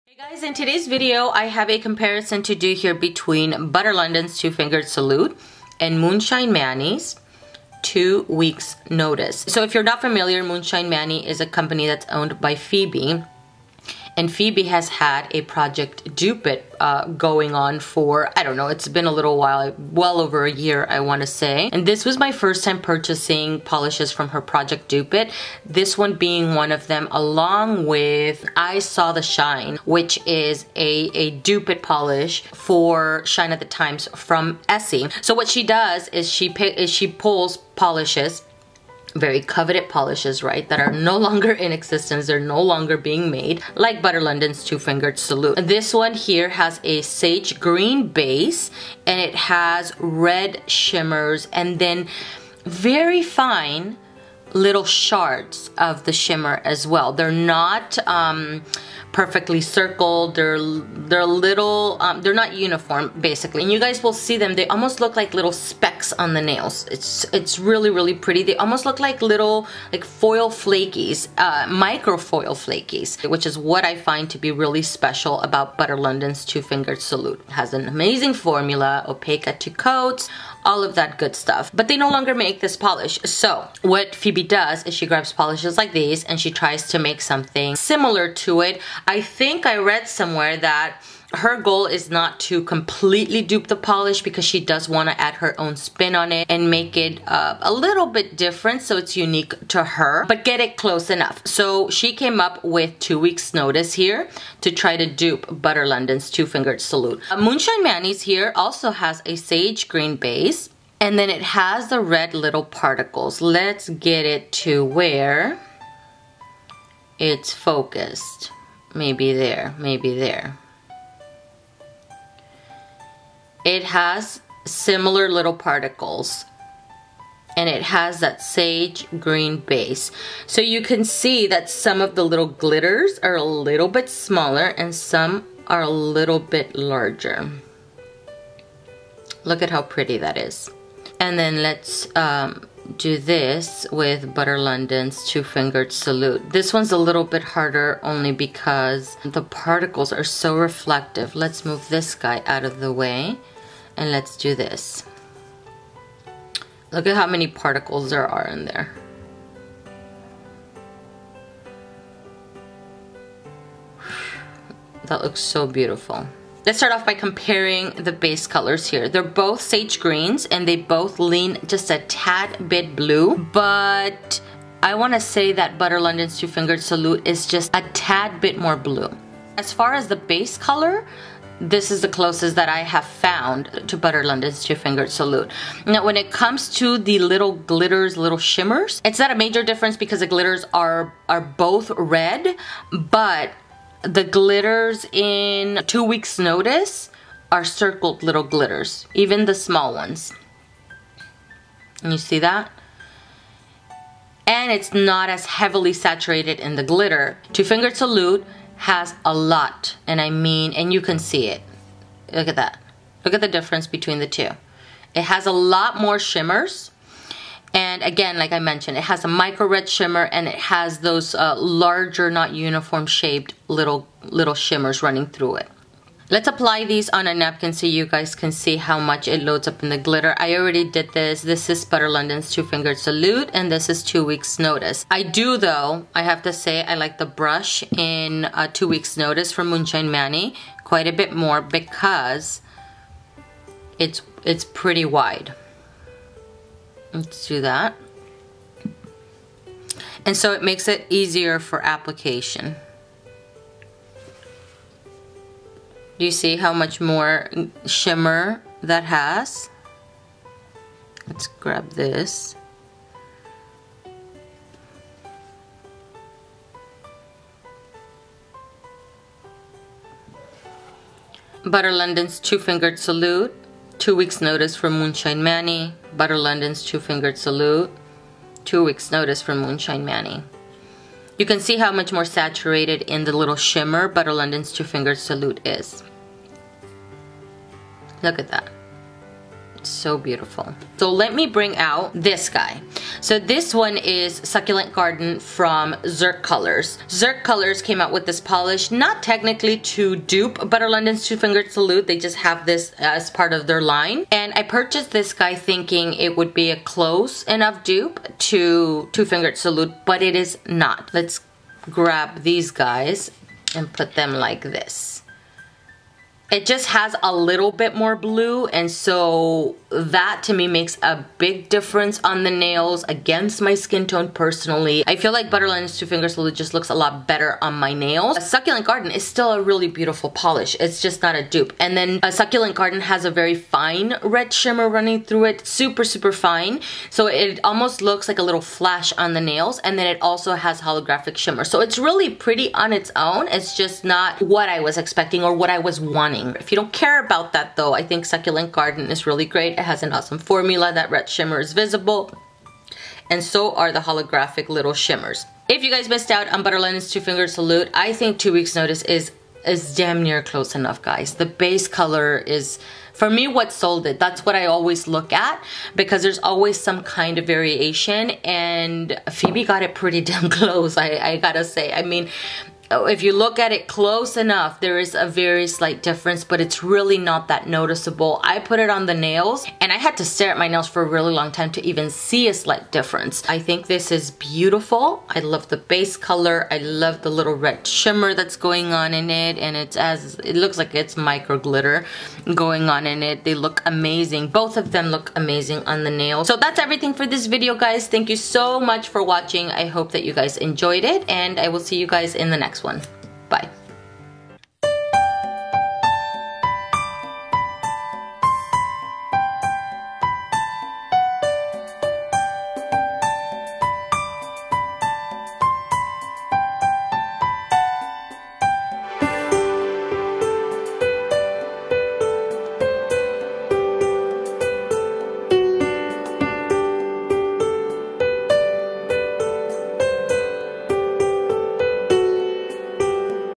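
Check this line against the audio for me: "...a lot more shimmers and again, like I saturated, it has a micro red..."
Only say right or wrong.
wrong.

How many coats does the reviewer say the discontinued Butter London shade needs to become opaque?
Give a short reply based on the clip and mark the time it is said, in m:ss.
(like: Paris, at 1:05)
2, at 1:19.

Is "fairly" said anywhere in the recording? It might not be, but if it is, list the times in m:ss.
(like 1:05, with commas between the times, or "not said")
not said.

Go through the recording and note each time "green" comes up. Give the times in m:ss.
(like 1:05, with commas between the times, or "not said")
0:47, 1:49, 2:09, 2:49.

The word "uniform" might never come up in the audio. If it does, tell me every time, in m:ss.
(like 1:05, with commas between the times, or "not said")
1:02, 3:42.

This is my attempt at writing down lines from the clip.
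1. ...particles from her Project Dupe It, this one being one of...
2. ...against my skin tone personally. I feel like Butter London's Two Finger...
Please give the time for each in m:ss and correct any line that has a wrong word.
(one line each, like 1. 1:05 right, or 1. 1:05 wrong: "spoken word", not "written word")
1. 0:23 wrong: "polishes", not "particles"
2. 5:23 right.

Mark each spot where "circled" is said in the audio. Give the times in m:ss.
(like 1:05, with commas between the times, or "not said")
0:59, 3:17.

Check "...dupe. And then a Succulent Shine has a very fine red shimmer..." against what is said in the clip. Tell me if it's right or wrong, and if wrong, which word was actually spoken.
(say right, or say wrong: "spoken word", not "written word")
wrong: "Garden", not "Shine".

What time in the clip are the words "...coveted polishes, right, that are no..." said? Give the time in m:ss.
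0:39.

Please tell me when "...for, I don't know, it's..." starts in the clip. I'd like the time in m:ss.
0:17.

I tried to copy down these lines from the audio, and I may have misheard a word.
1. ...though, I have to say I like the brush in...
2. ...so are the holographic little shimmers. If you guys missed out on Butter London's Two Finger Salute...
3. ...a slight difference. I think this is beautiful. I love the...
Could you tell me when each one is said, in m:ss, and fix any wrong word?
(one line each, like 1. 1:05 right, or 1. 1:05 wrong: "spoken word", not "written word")
1. 3:55 right
2. 5:53 right
3. 6:22 right.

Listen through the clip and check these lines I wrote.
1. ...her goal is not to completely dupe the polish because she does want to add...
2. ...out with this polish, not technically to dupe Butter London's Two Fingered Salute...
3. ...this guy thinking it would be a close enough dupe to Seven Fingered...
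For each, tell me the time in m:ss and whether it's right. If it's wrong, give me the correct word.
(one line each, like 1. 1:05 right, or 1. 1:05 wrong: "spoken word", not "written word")
1. 1:31 right
2. 4:58 right
3. 5:05 wrong: "Two", not "Seven".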